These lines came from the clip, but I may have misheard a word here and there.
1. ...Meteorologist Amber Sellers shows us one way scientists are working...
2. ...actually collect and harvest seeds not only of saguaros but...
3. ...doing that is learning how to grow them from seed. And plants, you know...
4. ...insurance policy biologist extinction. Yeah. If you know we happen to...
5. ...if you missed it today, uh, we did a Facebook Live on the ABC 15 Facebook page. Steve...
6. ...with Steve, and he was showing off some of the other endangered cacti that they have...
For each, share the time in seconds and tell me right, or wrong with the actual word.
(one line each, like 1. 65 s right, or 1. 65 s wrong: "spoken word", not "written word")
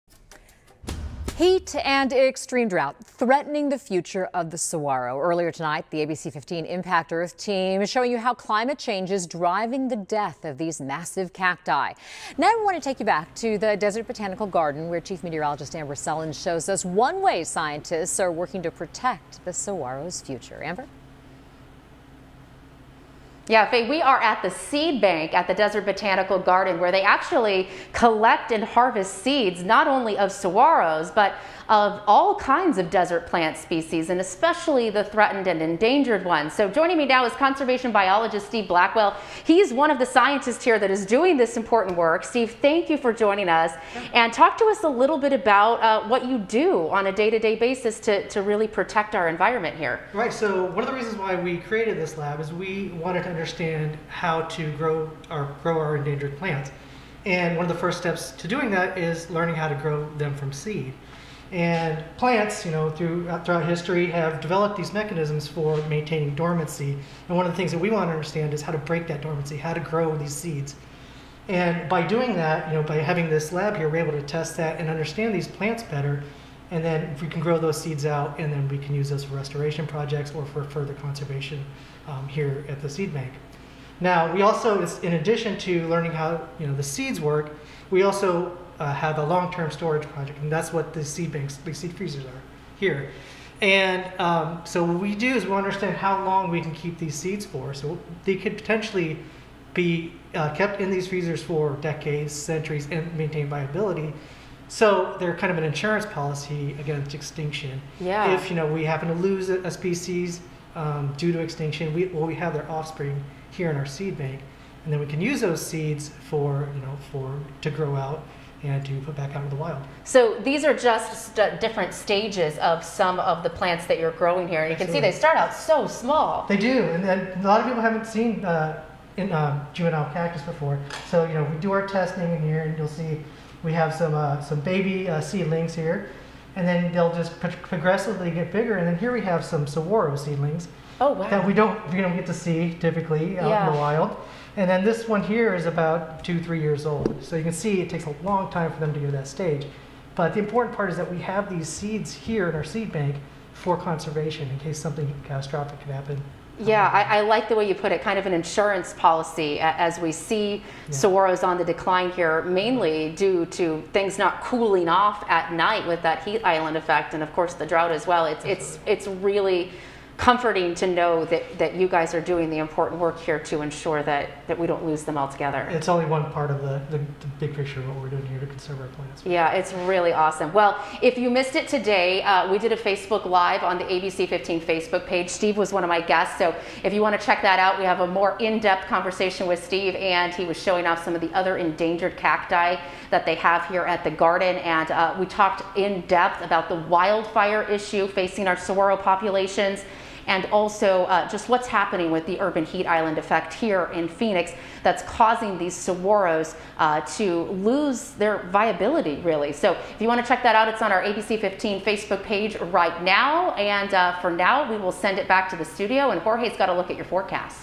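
1. 15 s right
2. 27 s right
3. 58 s right
4. 105 s wrong: "against", not "biologist"
5. 181 s right
6. 189 s right.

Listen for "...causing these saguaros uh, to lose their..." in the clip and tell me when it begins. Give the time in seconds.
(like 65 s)
205 s.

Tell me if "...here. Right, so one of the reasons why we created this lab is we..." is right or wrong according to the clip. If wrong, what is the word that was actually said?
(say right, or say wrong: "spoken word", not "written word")
right.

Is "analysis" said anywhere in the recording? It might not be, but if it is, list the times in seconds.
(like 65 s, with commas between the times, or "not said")
not said.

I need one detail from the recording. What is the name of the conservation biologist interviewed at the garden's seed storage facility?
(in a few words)
Steve Blackwell.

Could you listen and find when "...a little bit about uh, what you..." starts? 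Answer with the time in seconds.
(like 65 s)
44 s.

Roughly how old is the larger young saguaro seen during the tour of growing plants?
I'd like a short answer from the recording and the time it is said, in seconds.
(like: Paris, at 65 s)
2 to 3 years old, at 146 s.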